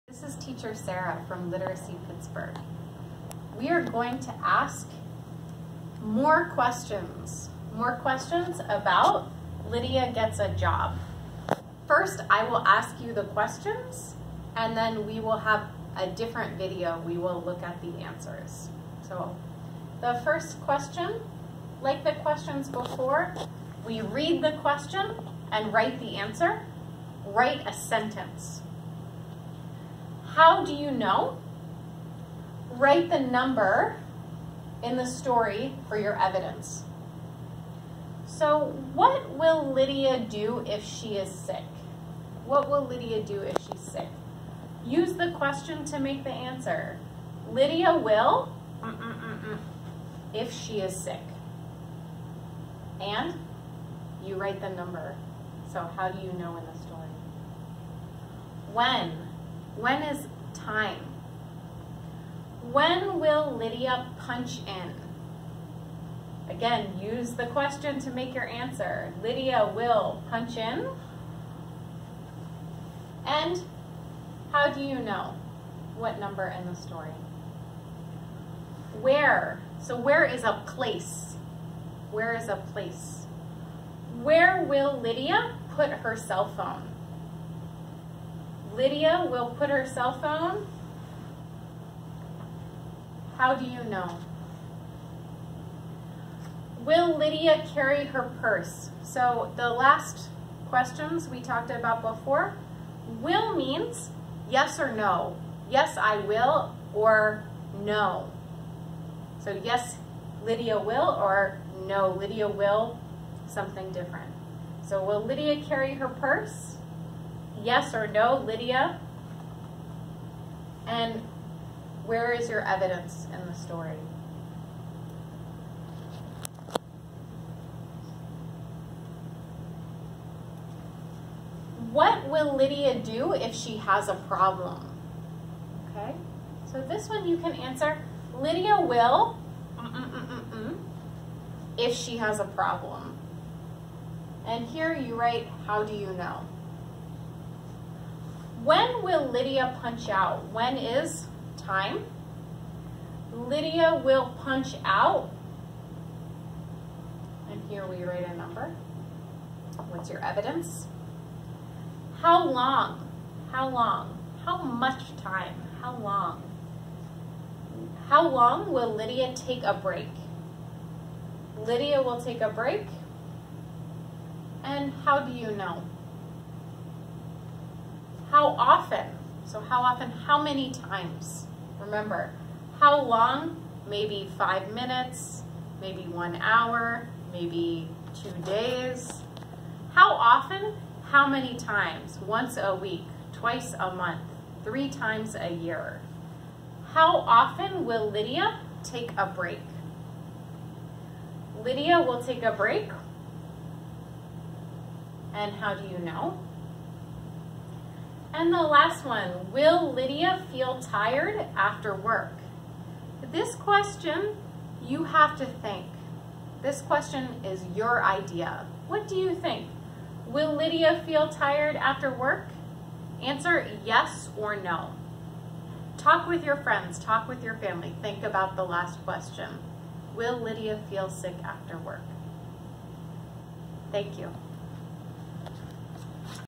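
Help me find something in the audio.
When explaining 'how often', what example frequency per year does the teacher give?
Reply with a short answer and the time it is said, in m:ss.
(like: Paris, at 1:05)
three times a year, at 3:14.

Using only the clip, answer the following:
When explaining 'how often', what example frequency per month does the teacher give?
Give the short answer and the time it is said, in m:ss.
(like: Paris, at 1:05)
twice a month, at 3:13.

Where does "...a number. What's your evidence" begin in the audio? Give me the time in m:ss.
2:38.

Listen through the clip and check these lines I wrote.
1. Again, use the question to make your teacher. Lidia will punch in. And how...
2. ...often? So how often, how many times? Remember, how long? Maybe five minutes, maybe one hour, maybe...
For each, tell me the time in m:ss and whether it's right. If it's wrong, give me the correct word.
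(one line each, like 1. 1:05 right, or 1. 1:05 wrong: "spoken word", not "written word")
1. 1:06 wrong: "answer", not "teacher"
2. 2:58 right.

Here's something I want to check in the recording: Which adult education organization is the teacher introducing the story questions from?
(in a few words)
Literacy Pittsburgh.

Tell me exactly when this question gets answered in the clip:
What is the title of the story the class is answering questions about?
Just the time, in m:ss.
0:09.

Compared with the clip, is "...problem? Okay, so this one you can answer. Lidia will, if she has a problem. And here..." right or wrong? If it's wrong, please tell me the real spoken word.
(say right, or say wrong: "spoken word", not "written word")
right.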